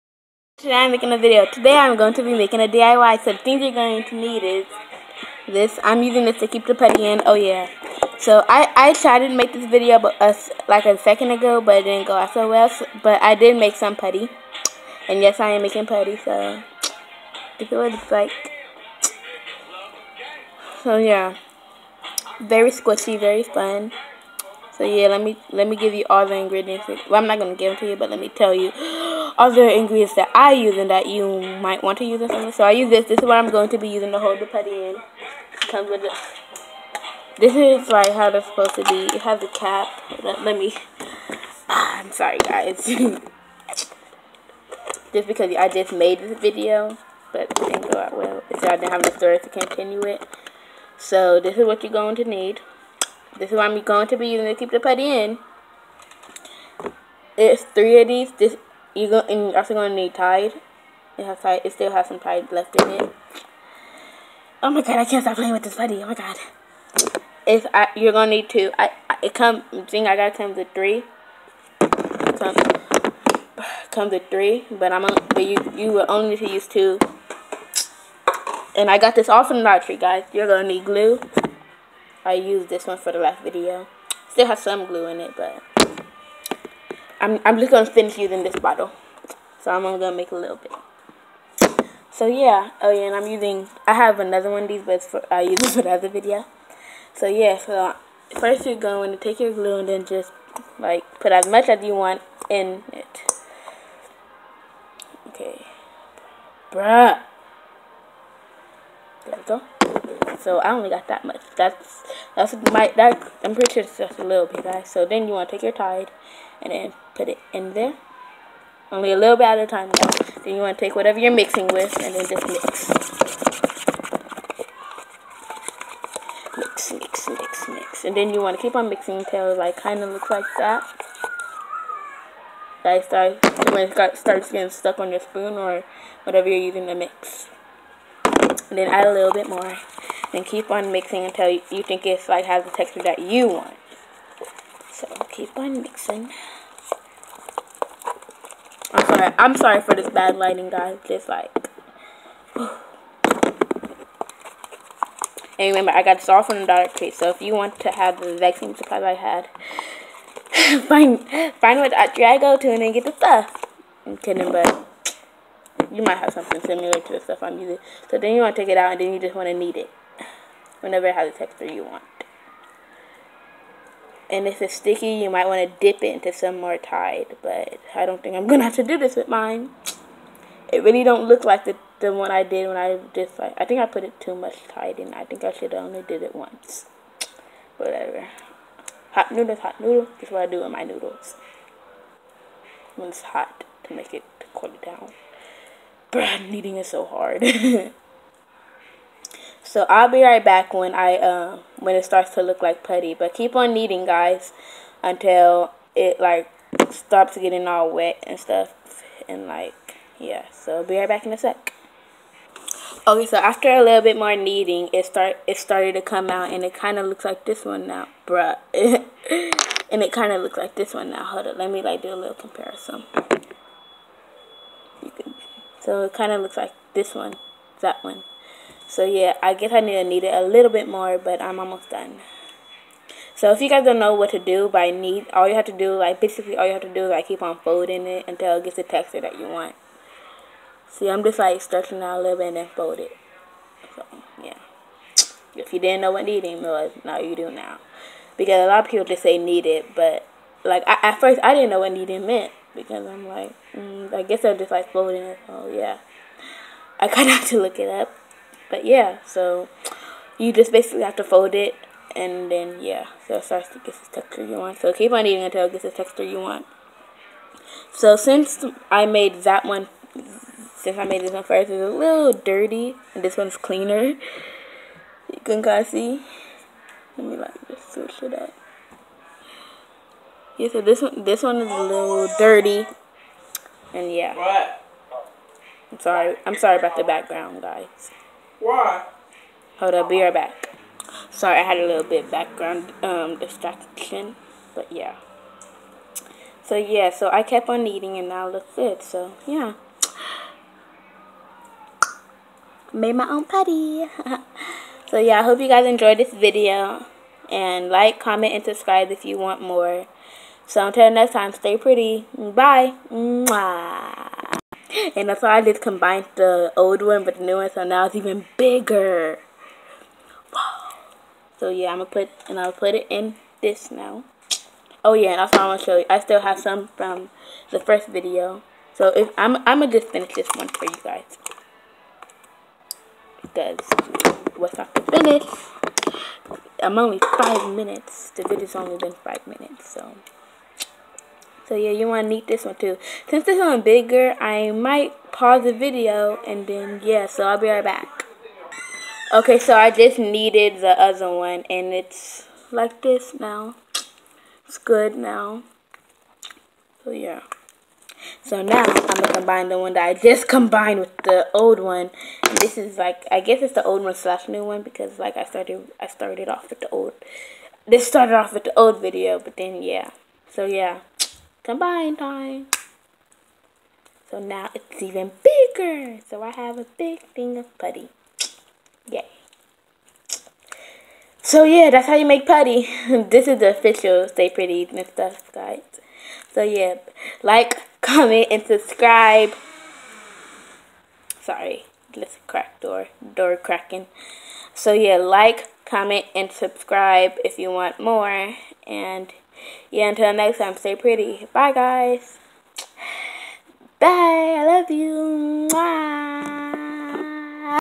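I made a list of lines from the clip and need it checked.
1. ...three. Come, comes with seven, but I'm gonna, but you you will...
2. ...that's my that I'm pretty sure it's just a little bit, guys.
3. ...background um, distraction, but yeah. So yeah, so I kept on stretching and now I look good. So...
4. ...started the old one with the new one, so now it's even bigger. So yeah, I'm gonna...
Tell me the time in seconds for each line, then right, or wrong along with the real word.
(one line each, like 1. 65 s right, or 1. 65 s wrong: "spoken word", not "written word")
1. 70 s wrong: "three", not "seven"
2. 112 s right
3. 292 s wrong: "eating", not "stretching"
4. 315 s wrong: "combined", not "started".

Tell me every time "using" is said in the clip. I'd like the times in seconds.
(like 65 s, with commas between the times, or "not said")
6 s, 33 s, 54 s, 88 s, 93 s, 136 s, 167 s.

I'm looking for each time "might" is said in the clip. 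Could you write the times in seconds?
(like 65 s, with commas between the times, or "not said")
31 s, 166 s, 175 s, 344 s.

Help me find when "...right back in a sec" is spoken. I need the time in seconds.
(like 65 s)
210 s.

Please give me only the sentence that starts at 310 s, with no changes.
So until next time, stay pretty.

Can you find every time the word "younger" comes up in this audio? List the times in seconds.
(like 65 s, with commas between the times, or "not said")
not said.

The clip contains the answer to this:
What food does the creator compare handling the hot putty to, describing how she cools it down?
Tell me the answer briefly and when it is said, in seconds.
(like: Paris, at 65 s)
Hot noodles, at 189 s.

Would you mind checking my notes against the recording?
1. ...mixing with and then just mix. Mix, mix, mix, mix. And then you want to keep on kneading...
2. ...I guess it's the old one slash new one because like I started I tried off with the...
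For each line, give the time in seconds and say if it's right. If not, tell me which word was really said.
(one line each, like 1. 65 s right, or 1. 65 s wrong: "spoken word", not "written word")
1. 121 s wrong: "mixing", not "kneading"
2. 363 s wrong: "started", not "tried".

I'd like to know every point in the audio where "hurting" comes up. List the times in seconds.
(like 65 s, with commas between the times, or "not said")
not said.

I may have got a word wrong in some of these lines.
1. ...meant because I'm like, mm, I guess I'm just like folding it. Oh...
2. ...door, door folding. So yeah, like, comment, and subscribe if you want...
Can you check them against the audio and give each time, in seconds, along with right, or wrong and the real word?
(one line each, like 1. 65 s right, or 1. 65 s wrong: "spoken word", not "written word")
1. 252 s right
2. 392 s wrong: "cracking", not "folding".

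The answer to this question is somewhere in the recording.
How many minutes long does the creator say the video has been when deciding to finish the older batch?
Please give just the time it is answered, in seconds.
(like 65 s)
338 s.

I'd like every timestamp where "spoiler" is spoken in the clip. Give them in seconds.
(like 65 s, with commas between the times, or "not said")
not said.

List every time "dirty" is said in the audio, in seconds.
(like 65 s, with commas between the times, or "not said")
272 s, 282 s.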